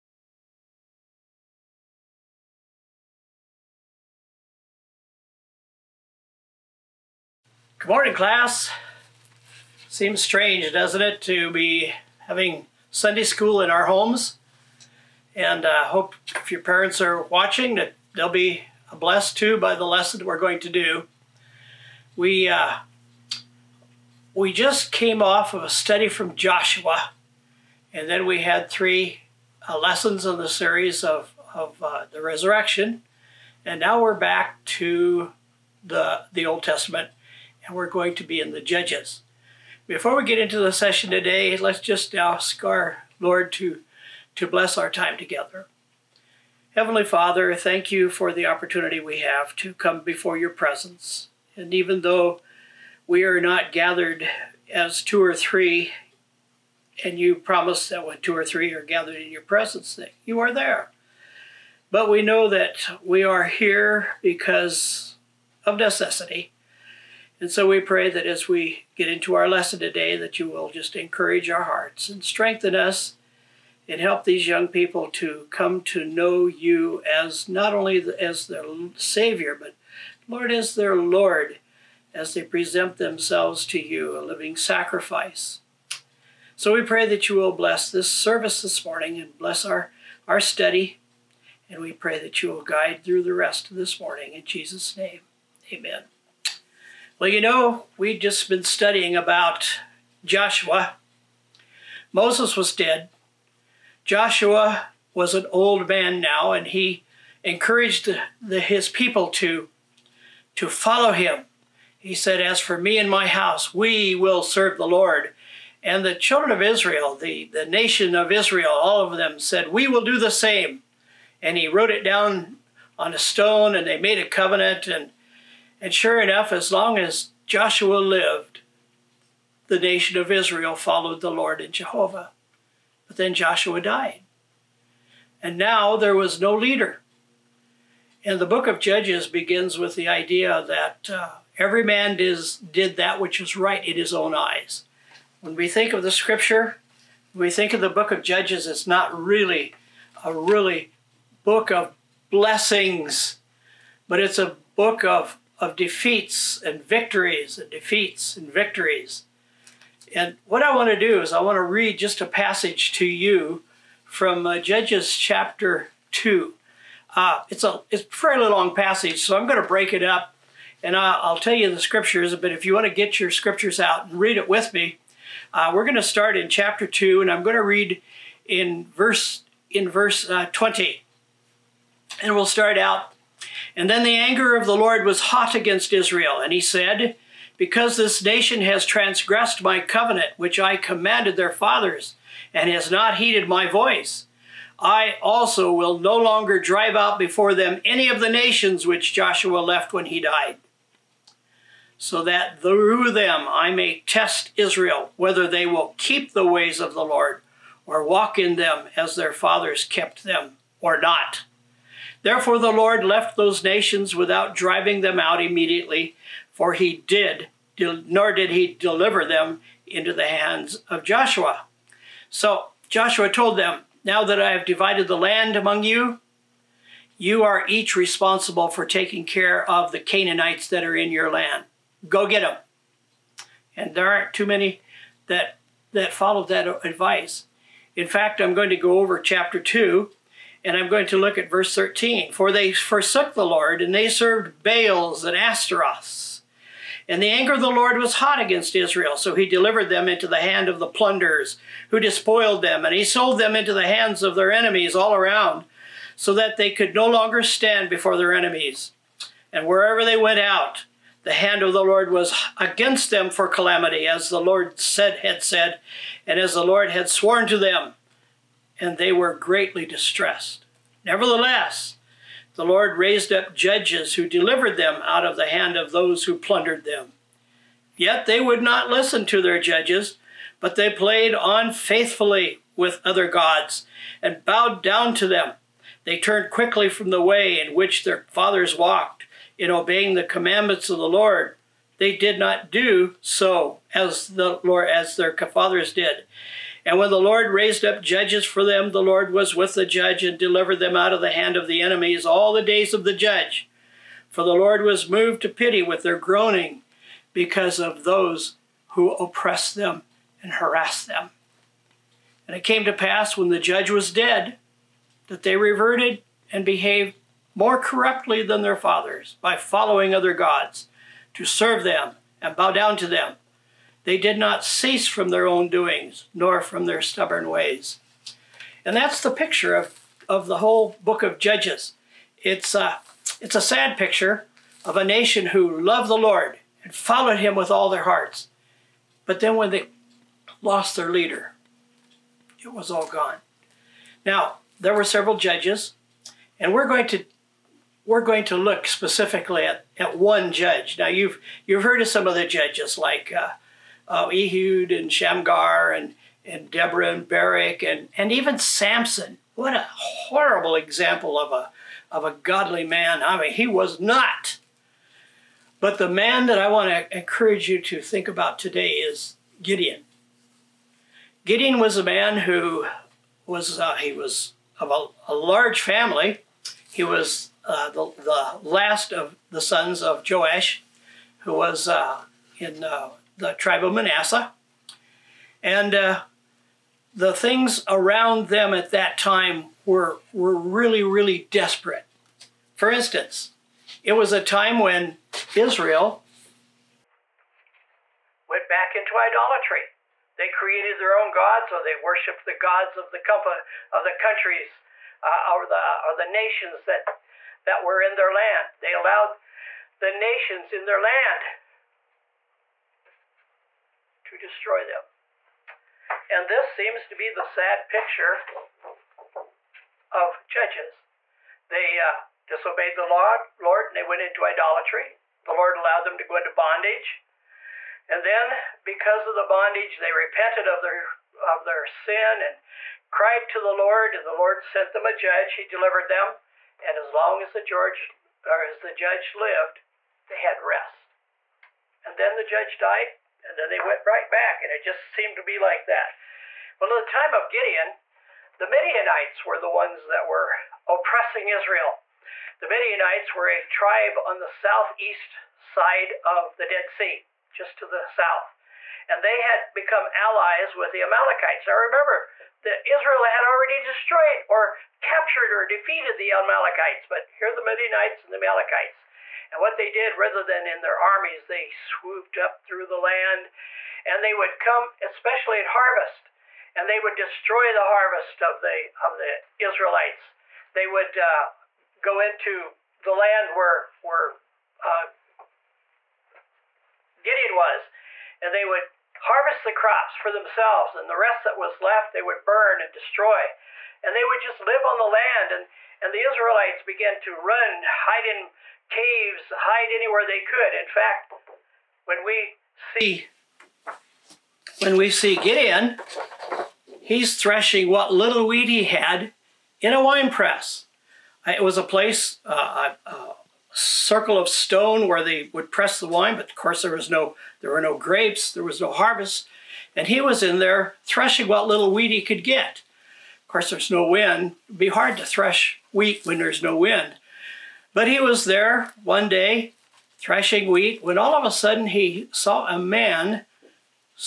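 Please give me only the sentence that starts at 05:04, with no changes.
For the Lord was moved to pity with their groaning because of those who oppressed them and harassed them.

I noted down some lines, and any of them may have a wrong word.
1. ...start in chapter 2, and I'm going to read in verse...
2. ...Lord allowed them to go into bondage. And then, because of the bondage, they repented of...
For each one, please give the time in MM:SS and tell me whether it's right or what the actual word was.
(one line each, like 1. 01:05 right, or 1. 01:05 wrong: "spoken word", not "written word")
1. 02:56 right
2. 07:05 right.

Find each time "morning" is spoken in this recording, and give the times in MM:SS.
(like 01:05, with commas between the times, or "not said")
00:07, 01:28, 01:33.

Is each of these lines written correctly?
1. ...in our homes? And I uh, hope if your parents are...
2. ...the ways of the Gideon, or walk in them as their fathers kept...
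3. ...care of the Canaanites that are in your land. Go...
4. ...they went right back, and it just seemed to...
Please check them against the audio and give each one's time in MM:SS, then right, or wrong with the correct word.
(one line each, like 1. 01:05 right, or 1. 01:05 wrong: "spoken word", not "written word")
1. 00:13 right
2. 03:26 wrong: "Lord", not "Gideon"
3. 03:49 right
4. 07:23 right.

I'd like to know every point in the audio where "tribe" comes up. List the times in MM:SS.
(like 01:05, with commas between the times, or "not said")
06:23, 07:33.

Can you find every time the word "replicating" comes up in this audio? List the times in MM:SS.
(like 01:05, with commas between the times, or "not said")
not said.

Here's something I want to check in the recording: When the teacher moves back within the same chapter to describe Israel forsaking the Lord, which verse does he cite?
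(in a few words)
Verse 13.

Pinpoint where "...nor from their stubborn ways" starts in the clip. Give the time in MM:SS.
05:26.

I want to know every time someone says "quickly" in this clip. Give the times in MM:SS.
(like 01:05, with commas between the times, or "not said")
04:46.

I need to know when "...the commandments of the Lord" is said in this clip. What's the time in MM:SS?
04:50.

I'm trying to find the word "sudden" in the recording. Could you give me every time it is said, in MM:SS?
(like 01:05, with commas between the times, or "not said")
08:51.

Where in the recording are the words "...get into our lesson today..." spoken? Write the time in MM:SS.
01:08.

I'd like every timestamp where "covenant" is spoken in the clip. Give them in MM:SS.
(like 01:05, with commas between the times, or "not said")
02:04, 03:09.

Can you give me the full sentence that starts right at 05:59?
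What a horrible example of a, of a godly man.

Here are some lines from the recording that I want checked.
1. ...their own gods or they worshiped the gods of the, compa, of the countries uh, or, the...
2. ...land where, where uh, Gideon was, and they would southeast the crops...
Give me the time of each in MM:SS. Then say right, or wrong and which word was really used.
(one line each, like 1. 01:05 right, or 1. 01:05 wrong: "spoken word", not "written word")
1. 06:40 right
2. 08:03 wrong: "harvest", not "southeast".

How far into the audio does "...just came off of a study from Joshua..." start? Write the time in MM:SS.
00:24.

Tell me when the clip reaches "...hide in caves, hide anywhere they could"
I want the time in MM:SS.
08:17.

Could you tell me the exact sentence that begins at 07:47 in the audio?
But here the Midianites and the Amalekites.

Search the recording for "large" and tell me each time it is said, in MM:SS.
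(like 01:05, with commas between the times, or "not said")
06:15.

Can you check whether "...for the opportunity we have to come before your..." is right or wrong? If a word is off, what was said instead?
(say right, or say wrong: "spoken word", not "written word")
right.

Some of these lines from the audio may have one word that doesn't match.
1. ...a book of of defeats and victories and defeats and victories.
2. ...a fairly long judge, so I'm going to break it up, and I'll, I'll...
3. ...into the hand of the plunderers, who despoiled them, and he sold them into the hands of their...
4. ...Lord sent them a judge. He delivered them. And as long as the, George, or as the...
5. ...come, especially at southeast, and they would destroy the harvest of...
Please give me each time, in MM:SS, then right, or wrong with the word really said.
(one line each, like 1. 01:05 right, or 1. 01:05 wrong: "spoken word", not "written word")
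1. 02:34 right
2. 02:48 wrong: "passage", not "judge"
3. 04:10 right
4. 07:14 right
5. 07:54 wrong: "harvest", not "southeast".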